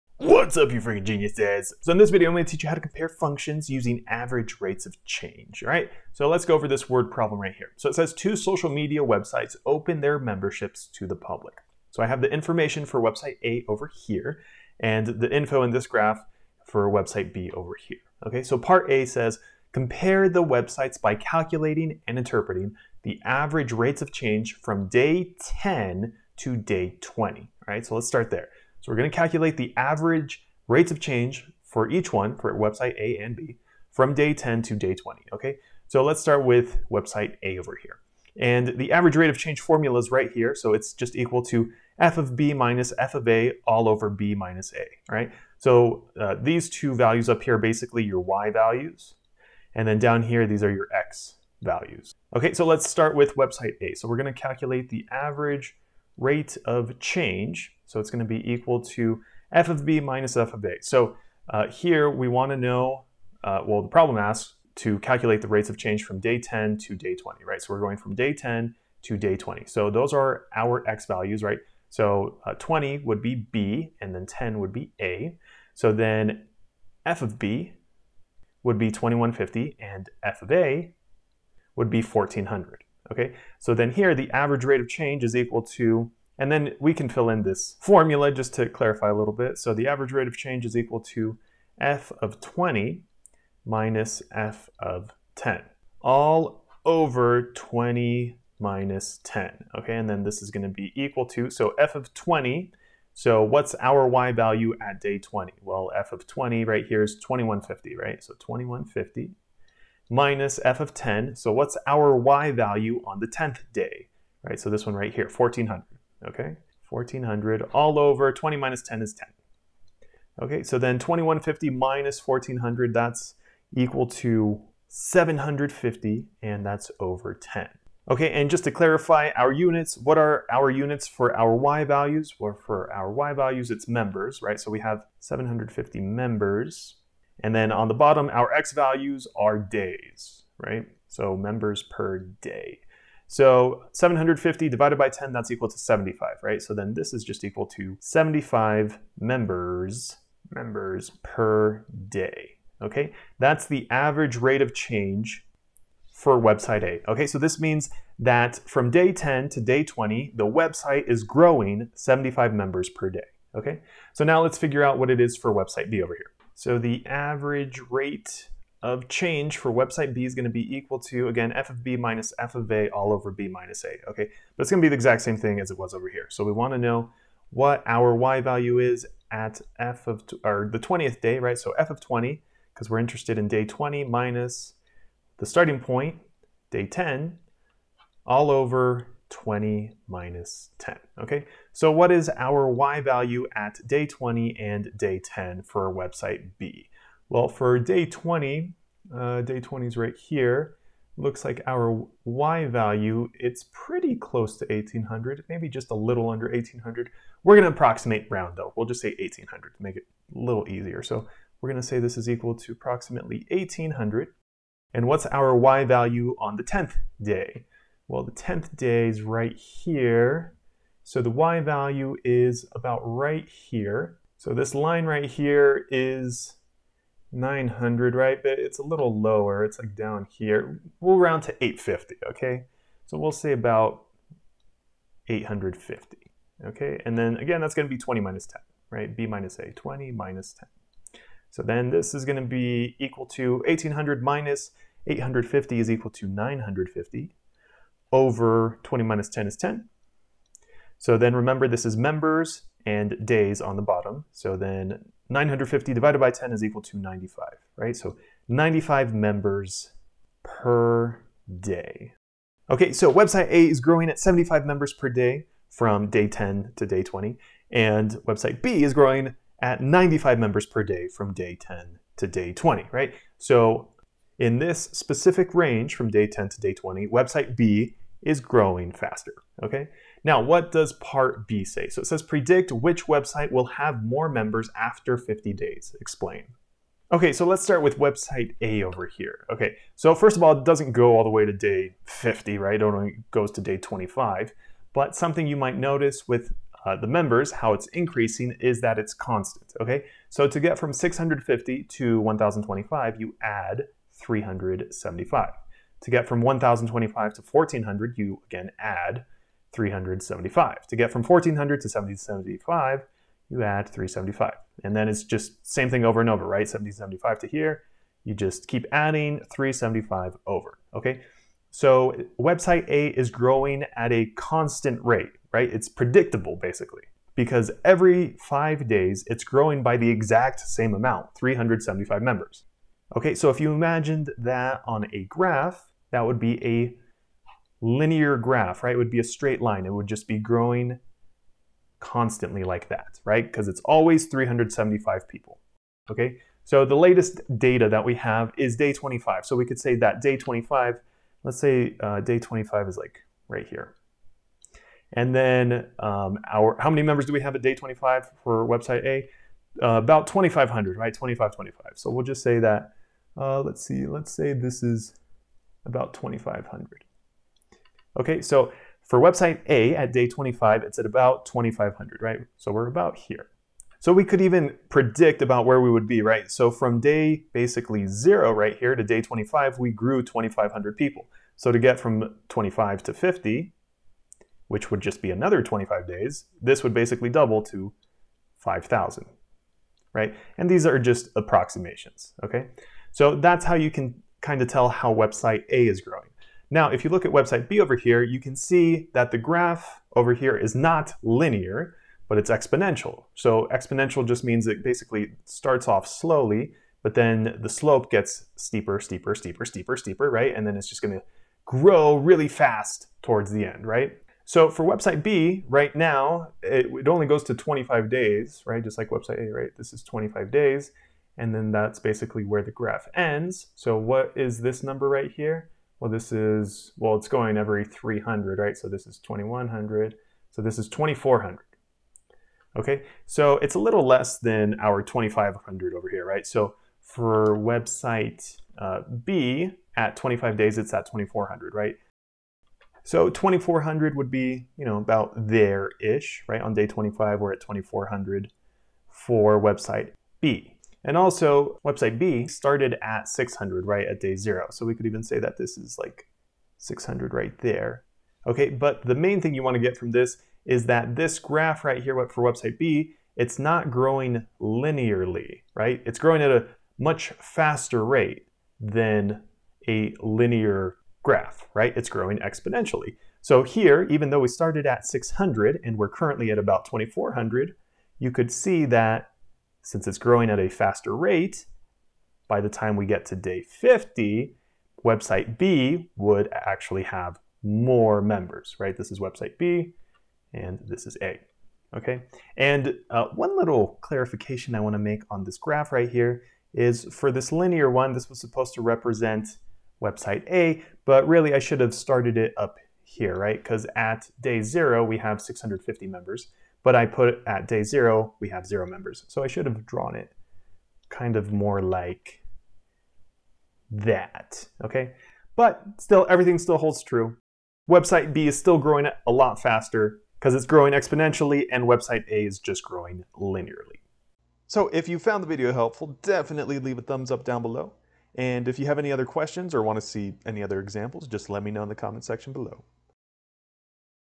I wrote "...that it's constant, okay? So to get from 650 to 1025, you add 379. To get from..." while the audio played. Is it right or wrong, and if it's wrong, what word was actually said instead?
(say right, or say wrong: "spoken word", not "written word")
wrong: "375", not "379".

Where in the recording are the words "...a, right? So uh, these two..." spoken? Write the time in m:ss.
0:44.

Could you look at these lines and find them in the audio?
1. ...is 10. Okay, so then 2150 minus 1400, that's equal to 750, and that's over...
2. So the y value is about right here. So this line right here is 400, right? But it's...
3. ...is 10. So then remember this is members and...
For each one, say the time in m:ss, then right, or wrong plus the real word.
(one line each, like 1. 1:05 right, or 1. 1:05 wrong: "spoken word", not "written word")
1. 1:59 right
2. 3:41 wrong: "900", not "400"
3. 4:09 right.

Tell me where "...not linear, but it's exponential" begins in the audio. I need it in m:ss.
6:40.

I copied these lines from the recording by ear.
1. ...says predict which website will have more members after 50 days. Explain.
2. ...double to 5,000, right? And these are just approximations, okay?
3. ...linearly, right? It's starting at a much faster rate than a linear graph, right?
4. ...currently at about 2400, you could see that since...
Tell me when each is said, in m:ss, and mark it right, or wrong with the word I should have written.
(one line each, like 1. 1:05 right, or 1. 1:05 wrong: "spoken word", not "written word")
1. 4:42 right
2. 6:27 right
3. 7:44 wrong: "growing", not "starting"
4. 7:56 right.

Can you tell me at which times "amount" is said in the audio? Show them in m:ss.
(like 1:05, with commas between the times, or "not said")
5:30.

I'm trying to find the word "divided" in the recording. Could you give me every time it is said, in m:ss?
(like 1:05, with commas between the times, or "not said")
2:24, 4:15.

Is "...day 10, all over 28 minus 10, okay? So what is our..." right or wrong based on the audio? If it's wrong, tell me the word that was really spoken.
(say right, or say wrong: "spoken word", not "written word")
wrong: "20", not "28".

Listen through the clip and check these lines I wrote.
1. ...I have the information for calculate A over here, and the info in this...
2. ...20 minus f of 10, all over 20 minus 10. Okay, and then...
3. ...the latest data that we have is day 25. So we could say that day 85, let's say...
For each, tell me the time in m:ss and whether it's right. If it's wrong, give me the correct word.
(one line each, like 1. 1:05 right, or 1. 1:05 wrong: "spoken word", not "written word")
1. 0:12 wrong: "website", not "calculate"
2. 1:32 right
3. 5:46 wrong: "25", not "85".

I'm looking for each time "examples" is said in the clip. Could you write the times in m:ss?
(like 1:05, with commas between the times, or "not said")
8:50.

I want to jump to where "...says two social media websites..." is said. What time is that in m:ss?
0:07.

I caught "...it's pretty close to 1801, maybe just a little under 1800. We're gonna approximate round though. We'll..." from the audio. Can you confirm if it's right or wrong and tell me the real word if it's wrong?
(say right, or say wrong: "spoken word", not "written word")
wrong: "1800", not "1801".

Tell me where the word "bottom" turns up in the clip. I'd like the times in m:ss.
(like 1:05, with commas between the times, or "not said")
2:17, 4:13.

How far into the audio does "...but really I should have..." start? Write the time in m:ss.
8:21.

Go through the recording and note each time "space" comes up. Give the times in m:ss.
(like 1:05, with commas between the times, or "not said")
not said.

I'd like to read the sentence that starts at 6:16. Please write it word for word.
So from day basically zero right here to day 25, we grew 2,500 people.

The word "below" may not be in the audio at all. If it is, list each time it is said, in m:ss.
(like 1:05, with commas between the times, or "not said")
8:47, 8:52.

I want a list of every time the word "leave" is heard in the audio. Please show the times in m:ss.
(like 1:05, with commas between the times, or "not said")
8:46.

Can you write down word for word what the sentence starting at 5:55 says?
And then um, our, how many members do we have at day 25 for website A?